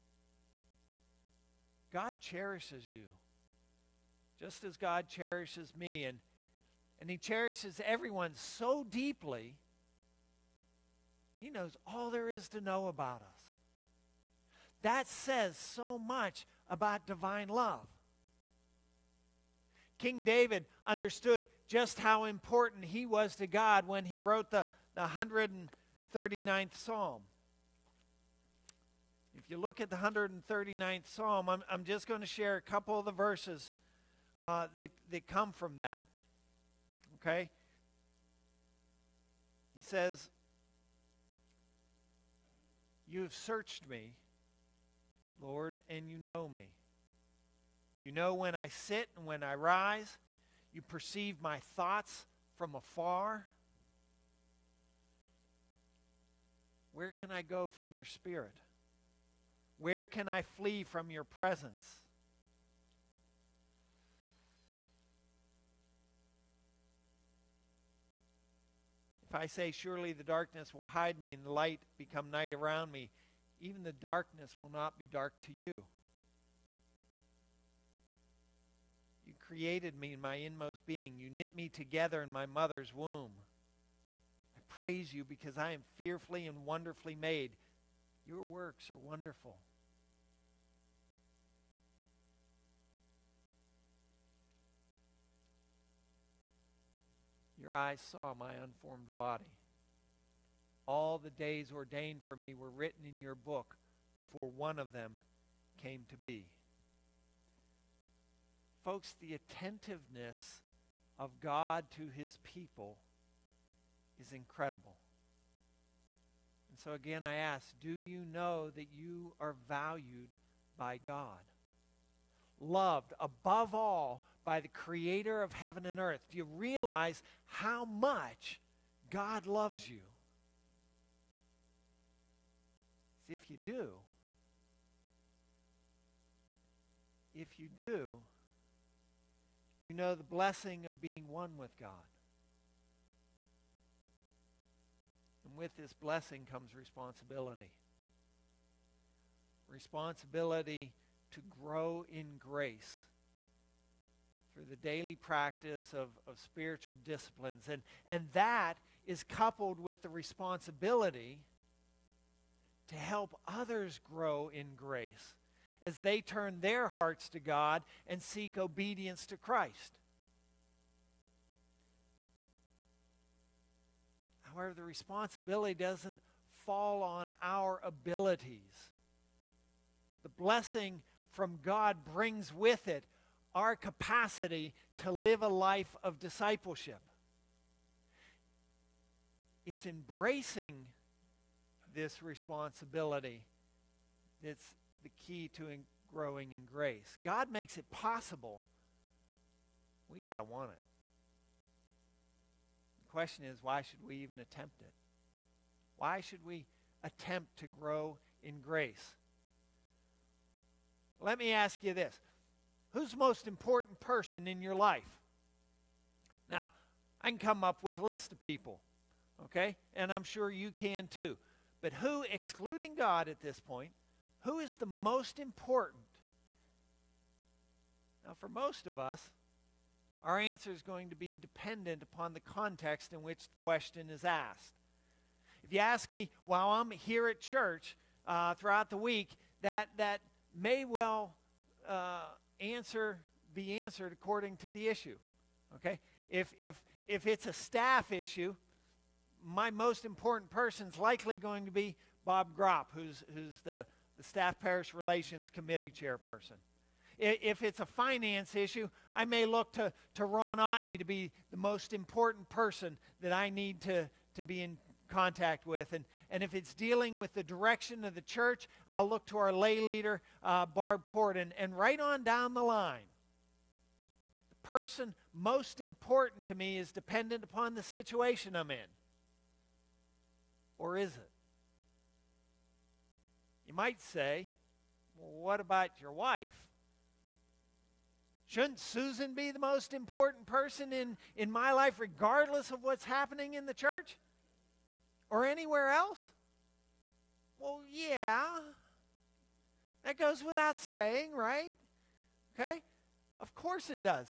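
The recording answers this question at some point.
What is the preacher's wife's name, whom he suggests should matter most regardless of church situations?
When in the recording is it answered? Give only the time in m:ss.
4:48.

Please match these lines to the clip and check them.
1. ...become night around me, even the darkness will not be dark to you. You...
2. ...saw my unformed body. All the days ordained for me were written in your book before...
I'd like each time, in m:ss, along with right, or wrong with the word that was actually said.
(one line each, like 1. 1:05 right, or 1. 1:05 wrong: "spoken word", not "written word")
1. 1:11 right
2. 1:38 right.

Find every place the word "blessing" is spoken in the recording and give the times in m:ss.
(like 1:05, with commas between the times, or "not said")
2:20, 2:25, 3:00.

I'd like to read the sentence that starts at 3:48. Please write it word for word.
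Now, for most of us, our answer is going to be dependent upon the context in which the question is asked.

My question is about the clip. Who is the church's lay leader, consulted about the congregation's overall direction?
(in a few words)
Barb Porton.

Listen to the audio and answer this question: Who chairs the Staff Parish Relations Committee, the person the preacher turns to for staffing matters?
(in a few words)
Bob Gropp.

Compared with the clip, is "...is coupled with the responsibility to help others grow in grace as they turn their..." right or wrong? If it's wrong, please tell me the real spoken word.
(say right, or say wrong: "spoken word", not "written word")
right.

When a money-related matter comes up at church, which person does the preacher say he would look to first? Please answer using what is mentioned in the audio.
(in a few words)
Ron Otney.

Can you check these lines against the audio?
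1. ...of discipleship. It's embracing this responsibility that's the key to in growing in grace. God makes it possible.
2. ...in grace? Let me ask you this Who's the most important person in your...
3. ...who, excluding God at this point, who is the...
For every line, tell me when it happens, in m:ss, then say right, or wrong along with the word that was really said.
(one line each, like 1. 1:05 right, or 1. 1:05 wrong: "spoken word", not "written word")
1. 3:06 right
2. 3:28 right
3. 3:41 right.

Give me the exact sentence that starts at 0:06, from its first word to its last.
And, and He cherishes everyone so deeply, He knows all there is to know about us.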